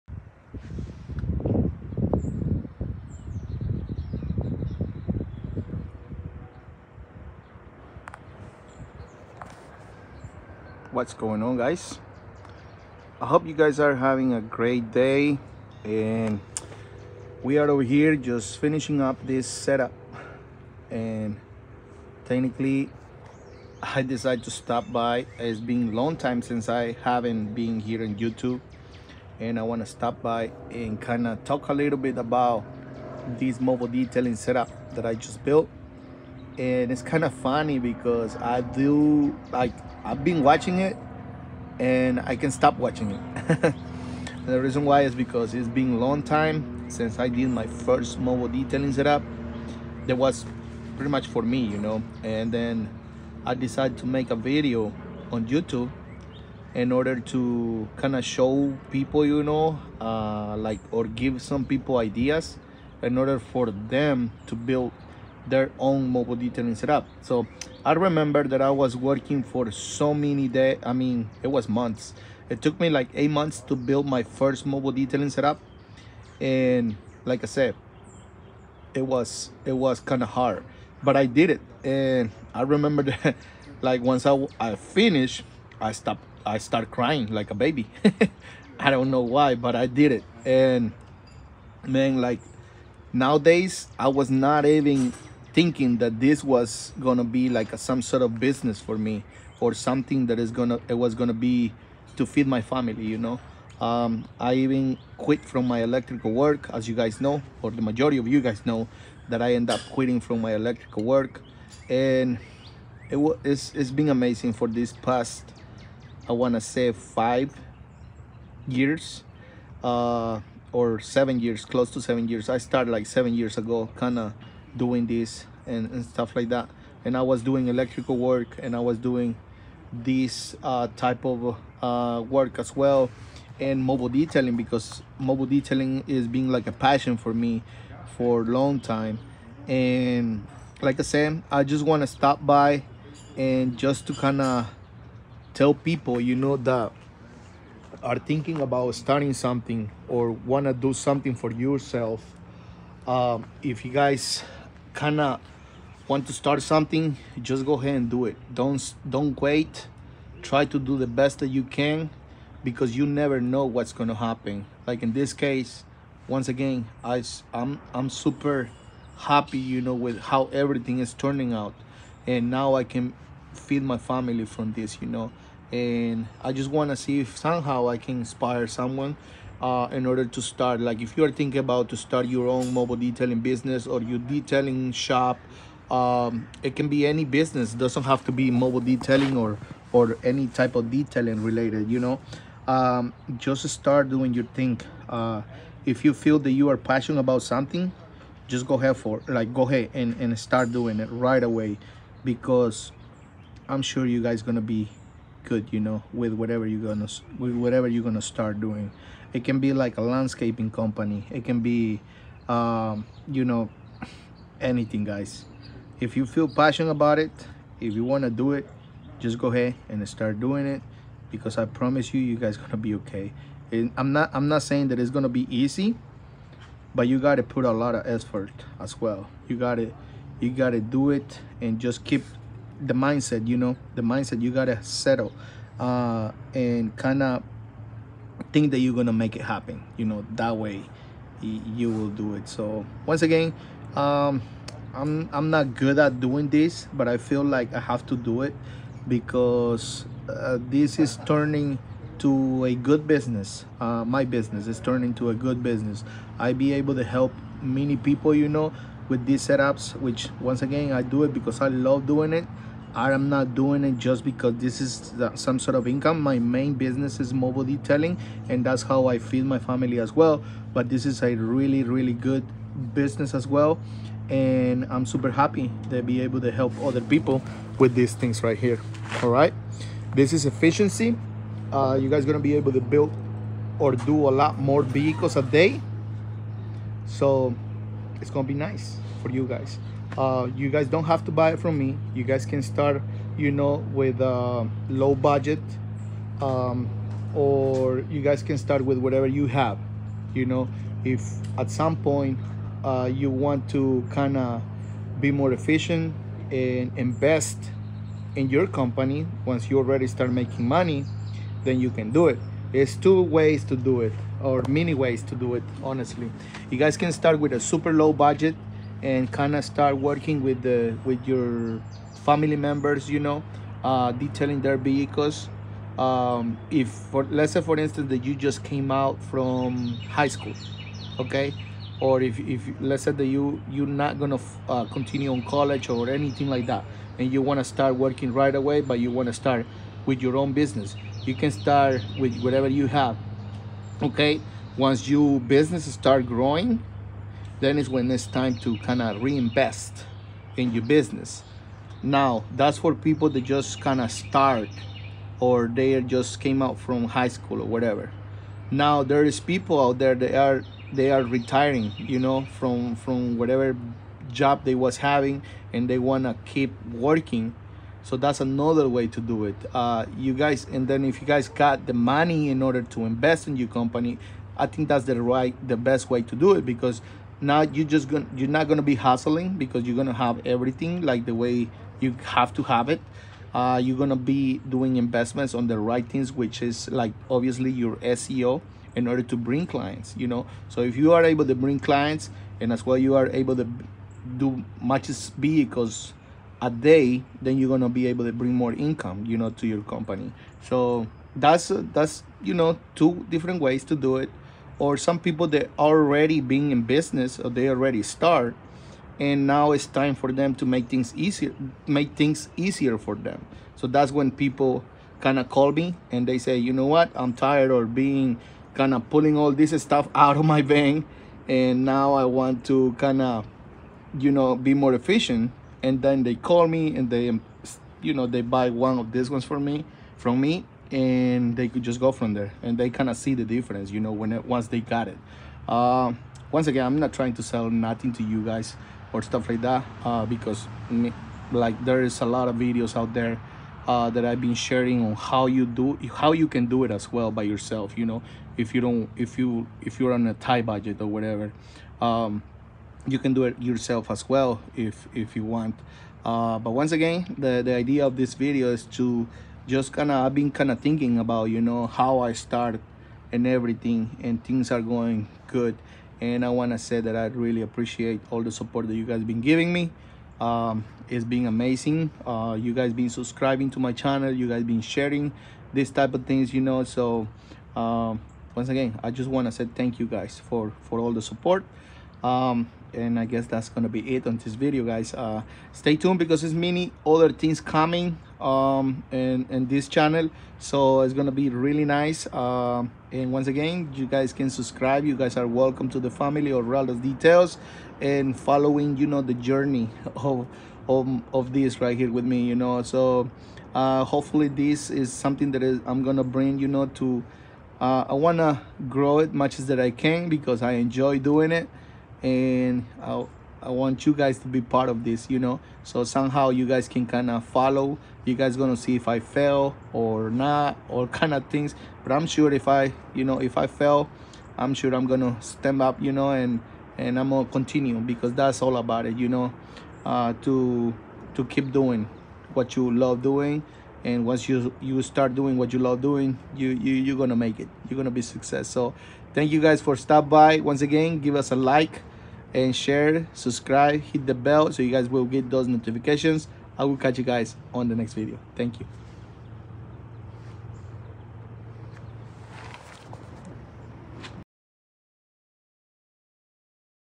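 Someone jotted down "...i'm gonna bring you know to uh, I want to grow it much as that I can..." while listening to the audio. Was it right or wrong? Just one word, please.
right.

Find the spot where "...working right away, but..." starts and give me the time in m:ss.
5:37.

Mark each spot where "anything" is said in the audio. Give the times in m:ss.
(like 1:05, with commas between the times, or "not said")
3:34, 5:36.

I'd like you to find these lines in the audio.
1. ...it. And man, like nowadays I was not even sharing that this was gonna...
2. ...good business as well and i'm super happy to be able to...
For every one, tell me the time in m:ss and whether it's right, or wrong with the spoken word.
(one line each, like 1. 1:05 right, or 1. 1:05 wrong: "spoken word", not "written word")
1. 1:30 wrong: "thinking", not "sharing"
2. 4:32 right.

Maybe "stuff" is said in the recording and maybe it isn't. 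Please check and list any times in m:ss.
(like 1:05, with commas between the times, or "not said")
2:06, 6:59, 7:19.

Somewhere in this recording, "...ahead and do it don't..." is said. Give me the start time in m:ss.
2:37.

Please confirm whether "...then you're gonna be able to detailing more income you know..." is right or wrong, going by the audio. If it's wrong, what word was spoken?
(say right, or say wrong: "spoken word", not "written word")
wrong: "bring", not "detailing".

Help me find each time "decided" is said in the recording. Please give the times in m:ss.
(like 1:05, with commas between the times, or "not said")
0:24, 0:53.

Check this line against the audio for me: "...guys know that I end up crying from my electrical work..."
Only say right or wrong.
wrong.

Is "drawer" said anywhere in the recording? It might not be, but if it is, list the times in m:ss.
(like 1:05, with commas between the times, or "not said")
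not said.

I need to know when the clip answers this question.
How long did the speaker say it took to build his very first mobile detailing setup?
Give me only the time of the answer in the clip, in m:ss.
1:13.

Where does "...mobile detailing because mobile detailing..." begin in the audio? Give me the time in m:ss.
2:13.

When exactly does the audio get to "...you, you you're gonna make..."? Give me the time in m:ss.
8:56.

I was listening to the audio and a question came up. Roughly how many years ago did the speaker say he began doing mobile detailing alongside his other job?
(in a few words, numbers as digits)
7 years.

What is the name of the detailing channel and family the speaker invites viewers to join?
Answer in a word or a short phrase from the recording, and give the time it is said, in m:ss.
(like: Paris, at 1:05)
Ralda's Details, at 8:16.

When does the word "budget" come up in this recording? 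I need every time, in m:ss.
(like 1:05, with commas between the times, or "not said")
4:55, 5:18, 7:30.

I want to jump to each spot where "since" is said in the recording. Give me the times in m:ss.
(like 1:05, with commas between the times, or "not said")
0:26, 0:46.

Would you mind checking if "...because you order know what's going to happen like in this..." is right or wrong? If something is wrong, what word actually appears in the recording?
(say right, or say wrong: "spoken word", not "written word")
wrong: "never", not "order".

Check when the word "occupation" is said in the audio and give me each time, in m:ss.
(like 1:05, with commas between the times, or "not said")
not said.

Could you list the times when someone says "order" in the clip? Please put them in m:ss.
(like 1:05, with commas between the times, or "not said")
0:56, 1:03, 3:00, 6:12, 6:29.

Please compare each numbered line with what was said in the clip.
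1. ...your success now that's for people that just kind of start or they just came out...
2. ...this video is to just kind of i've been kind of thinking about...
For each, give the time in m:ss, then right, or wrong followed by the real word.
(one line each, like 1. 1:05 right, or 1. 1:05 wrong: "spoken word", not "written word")
1. 5:50 wrong: "business", not "success"
2. 7:38 right.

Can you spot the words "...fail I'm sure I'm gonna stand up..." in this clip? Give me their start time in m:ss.
8:43.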